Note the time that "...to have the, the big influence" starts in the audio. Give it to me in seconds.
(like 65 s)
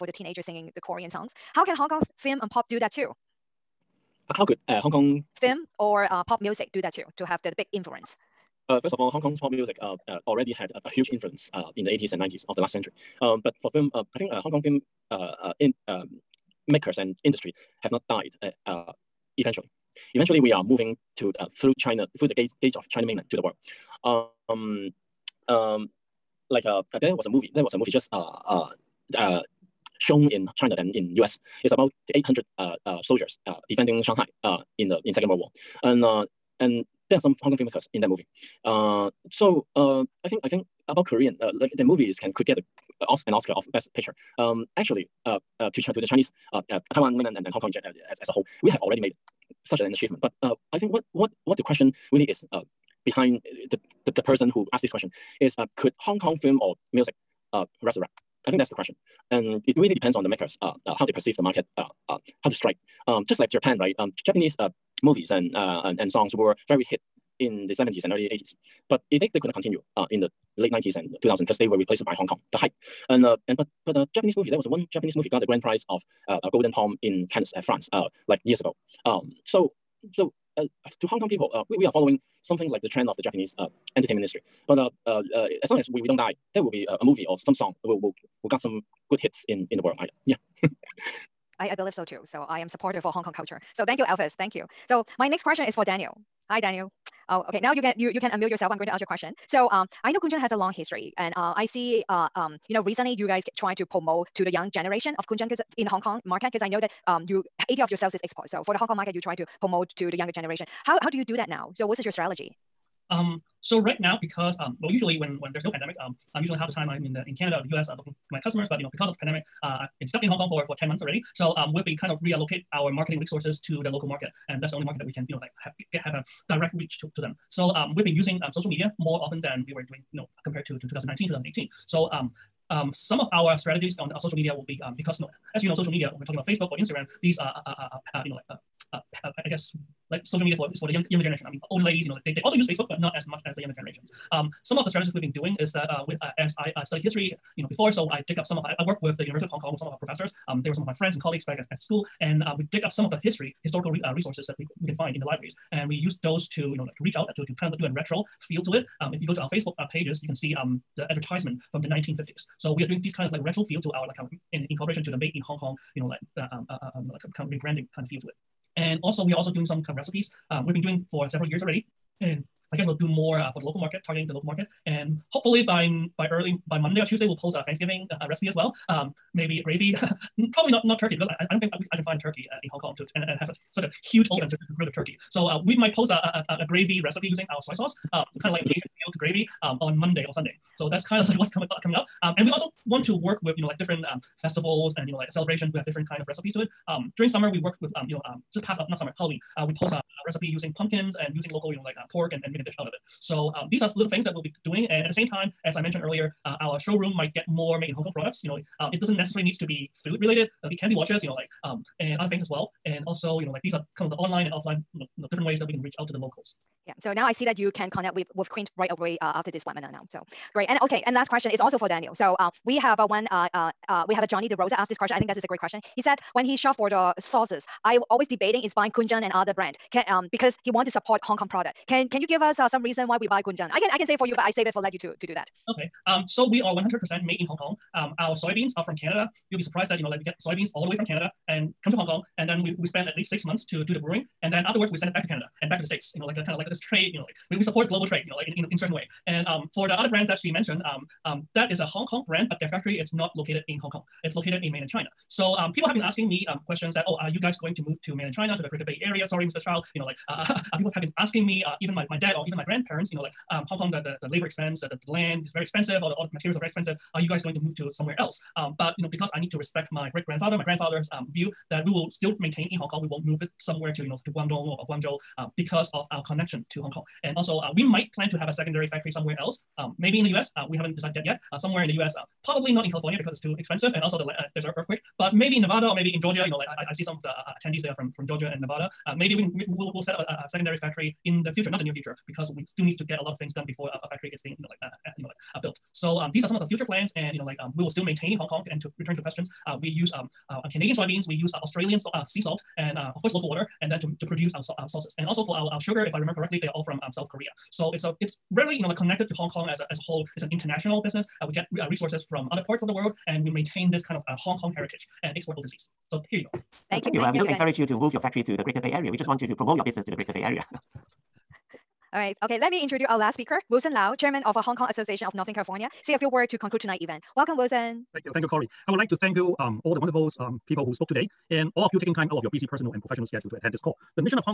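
7 s.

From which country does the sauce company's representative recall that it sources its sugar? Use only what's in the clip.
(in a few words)
South Korea.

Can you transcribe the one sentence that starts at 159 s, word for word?
Um, if you go to our Facebook uh, pages, you can see um, the advertisement from the 1950s.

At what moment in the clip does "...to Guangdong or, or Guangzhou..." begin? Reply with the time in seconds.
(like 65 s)
274 s.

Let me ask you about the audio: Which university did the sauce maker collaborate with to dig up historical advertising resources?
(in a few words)
University of Hong Kong.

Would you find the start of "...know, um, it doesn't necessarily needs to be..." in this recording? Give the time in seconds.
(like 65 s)
208 s.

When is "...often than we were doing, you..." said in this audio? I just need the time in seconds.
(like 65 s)
129 s.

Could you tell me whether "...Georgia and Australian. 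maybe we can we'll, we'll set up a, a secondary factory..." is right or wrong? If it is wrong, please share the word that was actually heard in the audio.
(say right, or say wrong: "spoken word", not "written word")
wrong: "Nevada", not "Australian".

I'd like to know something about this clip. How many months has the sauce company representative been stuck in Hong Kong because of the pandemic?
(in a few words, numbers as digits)
10.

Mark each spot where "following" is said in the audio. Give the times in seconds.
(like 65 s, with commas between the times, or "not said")
81 s.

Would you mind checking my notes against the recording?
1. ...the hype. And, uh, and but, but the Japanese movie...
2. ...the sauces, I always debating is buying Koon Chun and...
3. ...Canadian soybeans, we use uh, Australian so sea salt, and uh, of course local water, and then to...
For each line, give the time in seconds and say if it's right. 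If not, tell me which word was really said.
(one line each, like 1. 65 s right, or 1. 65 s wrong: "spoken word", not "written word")
1. 72 s right
2. 226 s right
3. 300 s right.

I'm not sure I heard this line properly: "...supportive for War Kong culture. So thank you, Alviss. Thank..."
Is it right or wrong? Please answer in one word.
wrong.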